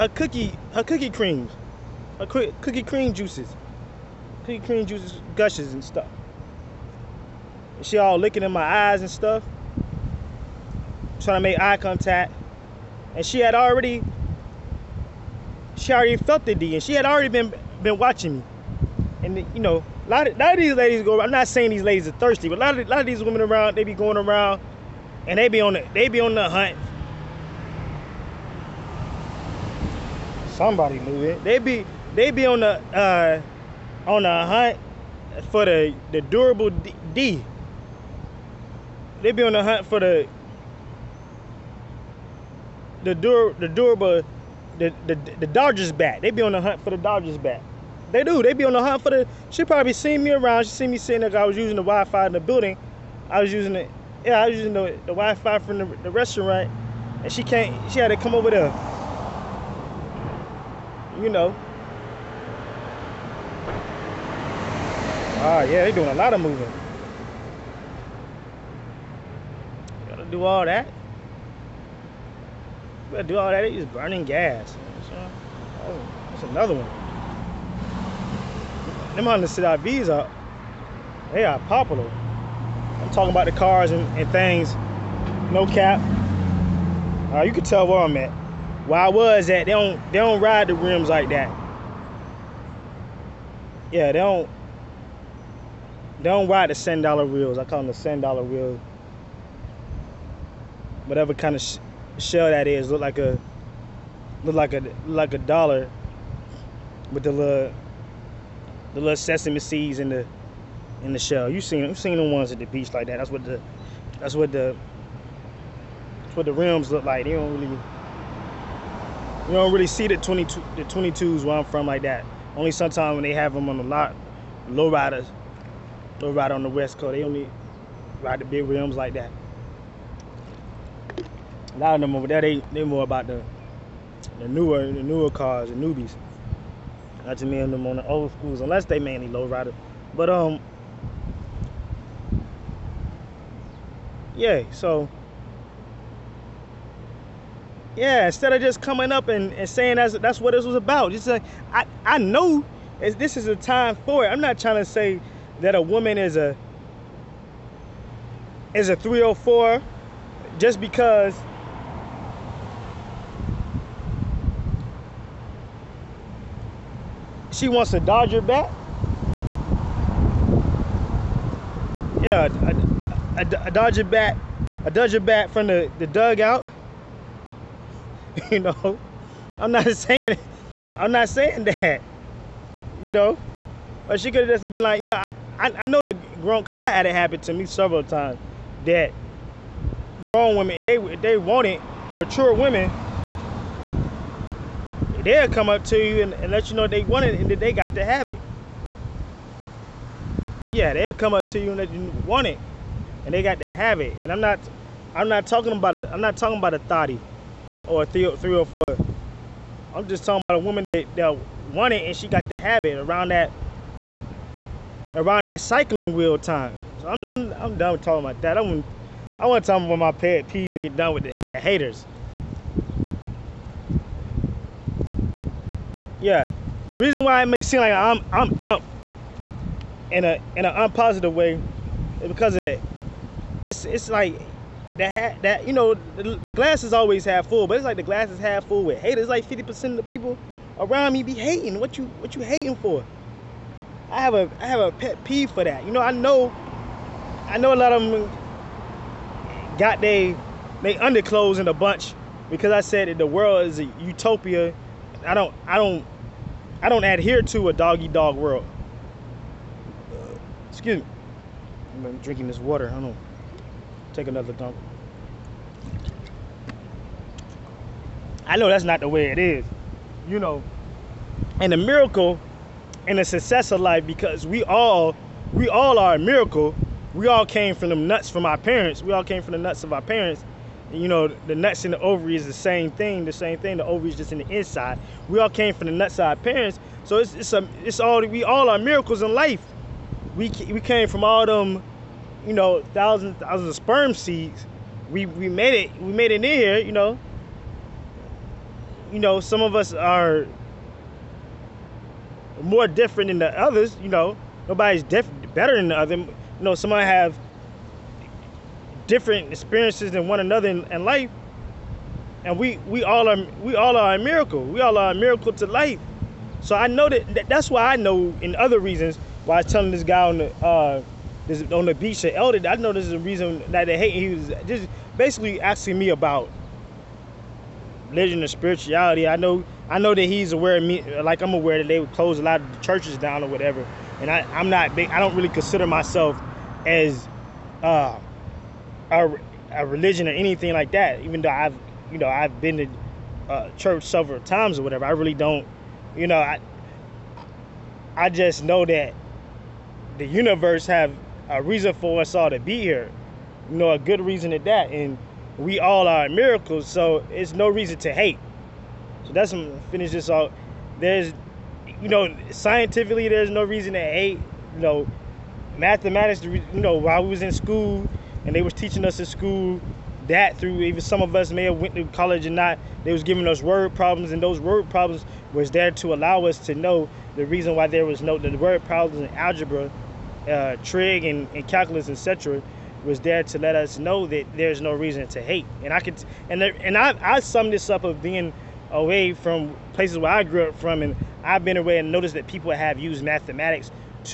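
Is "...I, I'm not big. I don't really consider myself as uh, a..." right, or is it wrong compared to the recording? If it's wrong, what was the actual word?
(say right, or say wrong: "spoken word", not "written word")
right.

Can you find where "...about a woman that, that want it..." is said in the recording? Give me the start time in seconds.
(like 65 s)
210 s.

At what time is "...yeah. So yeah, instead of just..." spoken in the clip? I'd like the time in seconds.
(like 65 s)
144 s.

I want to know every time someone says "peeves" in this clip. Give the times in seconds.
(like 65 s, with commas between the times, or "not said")
220 s, 245 s.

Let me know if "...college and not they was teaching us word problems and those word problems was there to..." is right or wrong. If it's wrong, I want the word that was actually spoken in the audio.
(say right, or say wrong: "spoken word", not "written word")
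wrong: "giving", not "teaching".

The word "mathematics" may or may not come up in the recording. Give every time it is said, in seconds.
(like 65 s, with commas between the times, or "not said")
365 s, 393 s.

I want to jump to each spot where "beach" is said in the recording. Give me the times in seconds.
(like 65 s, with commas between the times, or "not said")
112 s, 321 s.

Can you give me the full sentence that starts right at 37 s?
D they be on the hunt for the the dur the durable the, the the Dodgers bat.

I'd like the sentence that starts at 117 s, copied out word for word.
They don't really you don't really see the 22 the 22s where I'm from like that.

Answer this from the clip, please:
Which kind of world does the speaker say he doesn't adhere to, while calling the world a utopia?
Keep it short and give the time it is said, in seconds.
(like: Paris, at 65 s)
doggy dog world, at 257 s.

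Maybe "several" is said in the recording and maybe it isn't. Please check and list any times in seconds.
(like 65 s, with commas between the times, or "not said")
187 s, 344 s.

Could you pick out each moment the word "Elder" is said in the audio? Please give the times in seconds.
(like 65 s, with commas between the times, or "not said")
322 s.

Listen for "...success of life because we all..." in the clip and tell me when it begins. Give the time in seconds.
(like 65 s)
273 s.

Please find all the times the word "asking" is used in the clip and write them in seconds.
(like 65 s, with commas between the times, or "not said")
325 s.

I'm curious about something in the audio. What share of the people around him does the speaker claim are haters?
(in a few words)
50 percent.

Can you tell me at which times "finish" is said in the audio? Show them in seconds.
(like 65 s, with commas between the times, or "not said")
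359 s.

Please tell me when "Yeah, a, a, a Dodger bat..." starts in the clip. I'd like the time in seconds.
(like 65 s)
172 s.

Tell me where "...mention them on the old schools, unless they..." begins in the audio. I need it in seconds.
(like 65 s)
137 s.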